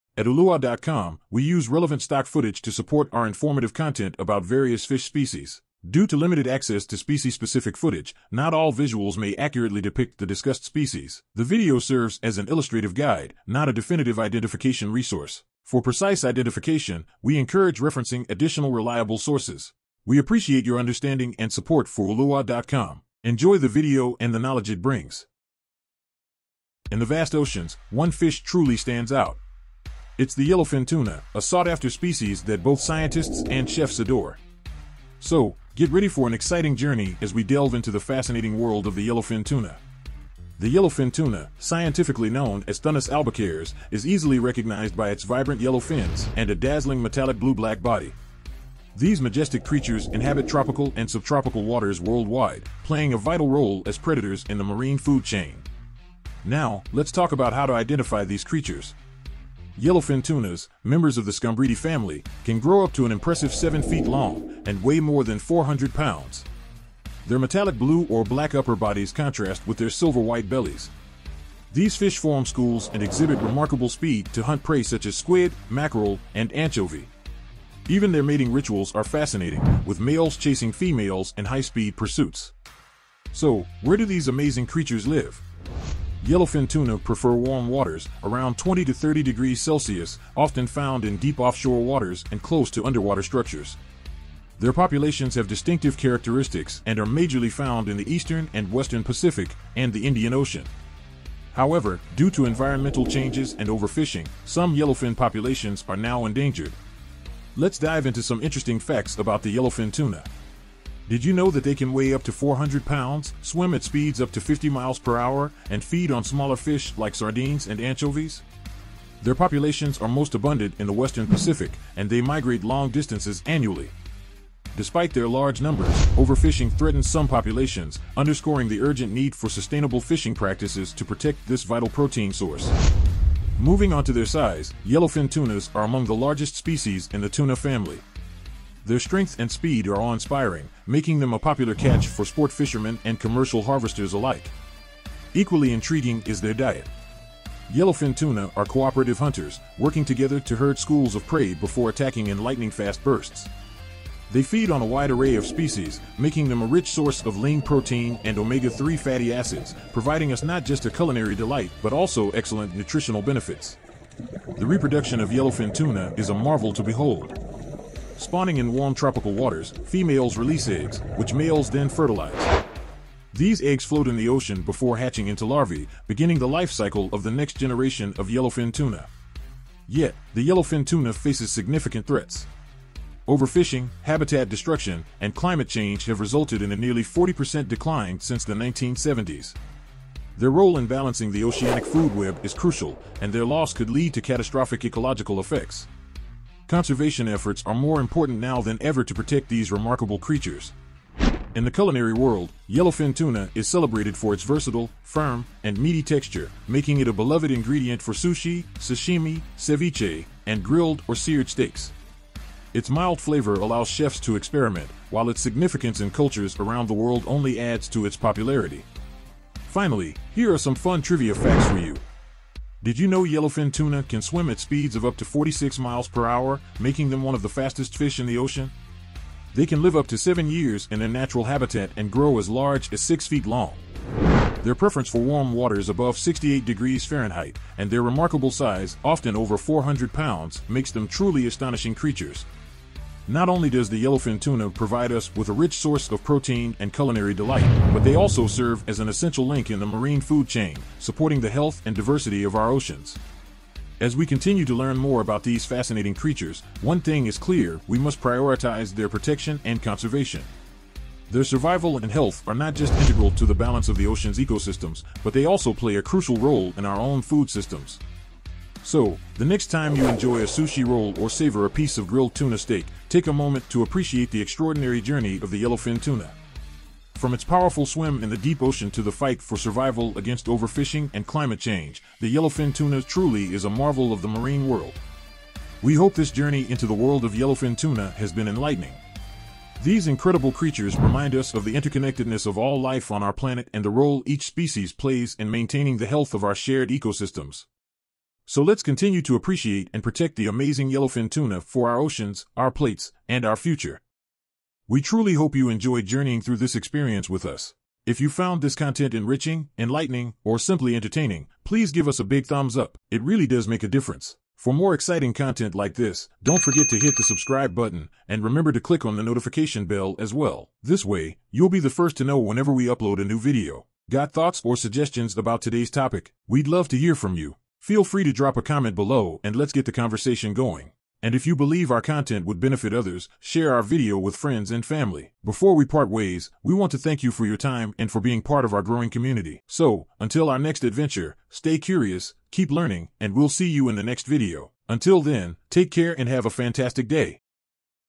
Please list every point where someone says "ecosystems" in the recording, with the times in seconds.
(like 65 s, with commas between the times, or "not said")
264 s, 296 s.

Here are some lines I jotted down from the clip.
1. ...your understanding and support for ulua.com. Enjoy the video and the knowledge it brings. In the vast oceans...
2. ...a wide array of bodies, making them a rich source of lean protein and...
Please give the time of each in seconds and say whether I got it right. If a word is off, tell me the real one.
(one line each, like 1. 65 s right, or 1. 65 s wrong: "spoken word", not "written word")
1. 20 s right
2. 154 s wrong: "species", not "bodies".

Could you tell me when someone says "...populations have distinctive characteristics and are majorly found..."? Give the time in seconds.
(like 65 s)
94 s.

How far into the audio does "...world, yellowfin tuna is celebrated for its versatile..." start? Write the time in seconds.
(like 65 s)
202 s.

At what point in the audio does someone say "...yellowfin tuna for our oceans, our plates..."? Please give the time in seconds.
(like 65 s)
300 s.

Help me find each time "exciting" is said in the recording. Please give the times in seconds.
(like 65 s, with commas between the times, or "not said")
36 s, 314 s.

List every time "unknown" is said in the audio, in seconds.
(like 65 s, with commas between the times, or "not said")
not said.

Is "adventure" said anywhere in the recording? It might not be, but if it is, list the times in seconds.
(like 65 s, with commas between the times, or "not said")
340 s.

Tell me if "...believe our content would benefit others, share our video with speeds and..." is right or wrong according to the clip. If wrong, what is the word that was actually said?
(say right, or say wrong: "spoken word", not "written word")
wrong: "friends", not "speeds".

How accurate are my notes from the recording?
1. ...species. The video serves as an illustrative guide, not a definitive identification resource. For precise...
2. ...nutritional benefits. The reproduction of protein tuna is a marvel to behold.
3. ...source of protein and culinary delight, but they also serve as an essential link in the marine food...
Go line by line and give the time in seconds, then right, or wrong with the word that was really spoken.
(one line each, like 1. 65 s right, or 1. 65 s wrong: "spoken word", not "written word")
1. 10 s right
2. 162 s wrong: "yellowfin", not "protein"
3. 245 s right.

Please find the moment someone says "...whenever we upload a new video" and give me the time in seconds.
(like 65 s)
322 s.